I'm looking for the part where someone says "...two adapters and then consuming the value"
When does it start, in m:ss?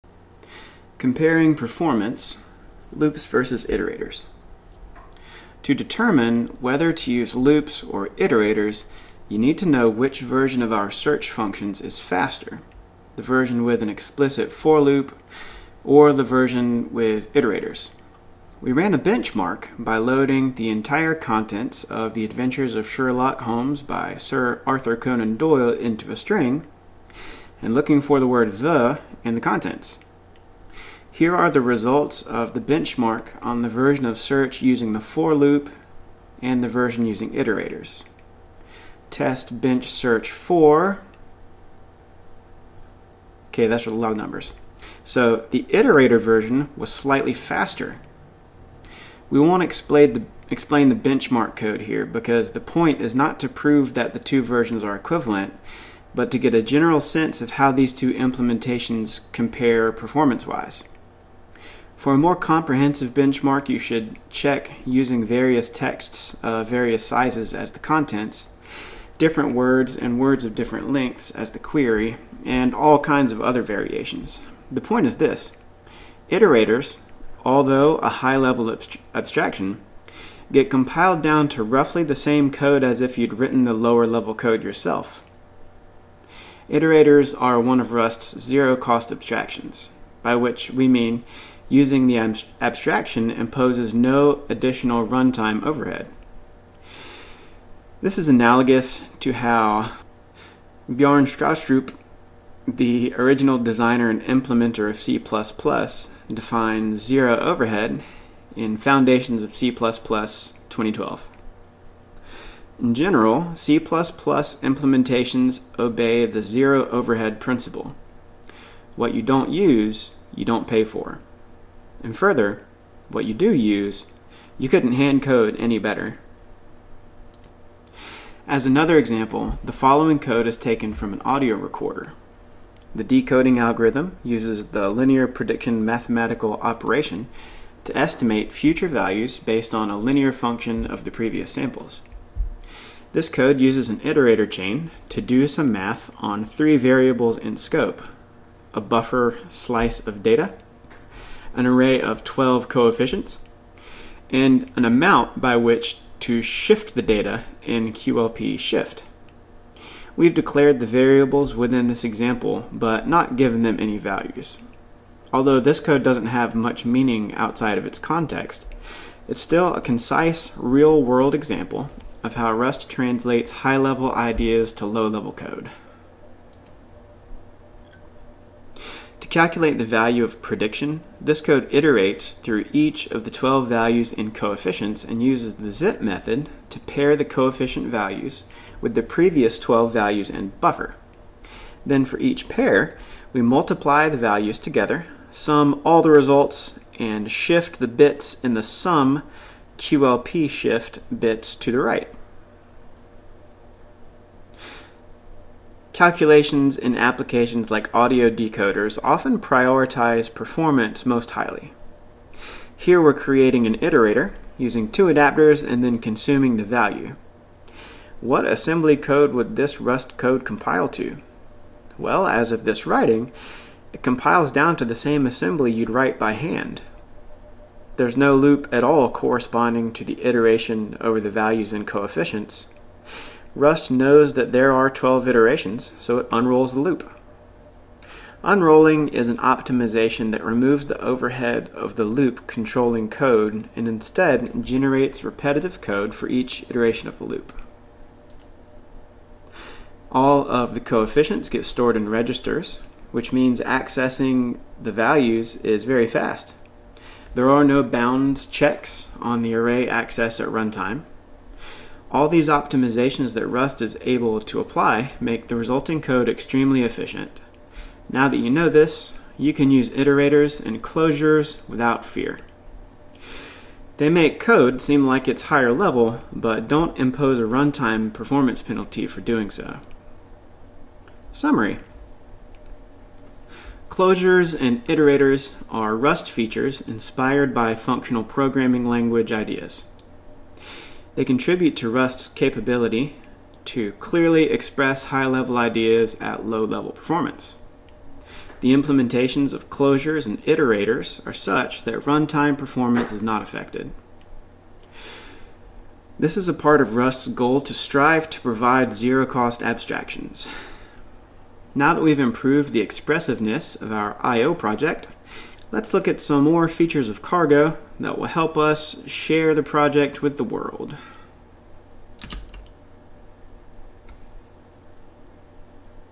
3:34.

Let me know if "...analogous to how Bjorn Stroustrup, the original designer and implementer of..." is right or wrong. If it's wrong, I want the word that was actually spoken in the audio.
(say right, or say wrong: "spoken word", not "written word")
right.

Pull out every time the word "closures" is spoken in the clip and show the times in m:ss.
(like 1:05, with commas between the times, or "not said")
4:30, 4:43, 4:59.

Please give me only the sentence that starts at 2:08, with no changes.
As another example, the following code is taken from an audio decoder.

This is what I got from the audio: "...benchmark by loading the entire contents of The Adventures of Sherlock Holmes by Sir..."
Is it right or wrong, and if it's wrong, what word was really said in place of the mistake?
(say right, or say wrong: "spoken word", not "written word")
right.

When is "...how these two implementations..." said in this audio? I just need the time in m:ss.
0:57.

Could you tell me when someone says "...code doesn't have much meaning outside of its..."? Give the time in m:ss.
2:45.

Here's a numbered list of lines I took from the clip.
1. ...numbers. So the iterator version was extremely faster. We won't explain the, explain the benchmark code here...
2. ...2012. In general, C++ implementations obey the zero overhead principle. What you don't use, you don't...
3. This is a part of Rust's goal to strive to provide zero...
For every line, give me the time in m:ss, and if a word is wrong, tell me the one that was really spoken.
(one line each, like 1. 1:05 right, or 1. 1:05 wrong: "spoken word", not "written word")
1. 0:44 wrong: "slightly", not "extremely"
2. 1:49 right
3. 5:06 right.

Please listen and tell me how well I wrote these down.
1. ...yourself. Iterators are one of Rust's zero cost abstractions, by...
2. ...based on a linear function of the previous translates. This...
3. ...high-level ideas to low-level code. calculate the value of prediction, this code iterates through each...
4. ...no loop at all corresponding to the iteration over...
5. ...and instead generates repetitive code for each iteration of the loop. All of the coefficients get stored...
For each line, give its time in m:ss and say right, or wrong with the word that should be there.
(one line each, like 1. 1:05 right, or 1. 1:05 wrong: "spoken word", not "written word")
1. 1:24 right
2. 2:19 wrong: "samples", not "translates"
3. 2:53 right
4. 3:48 right
5. 4:03 right.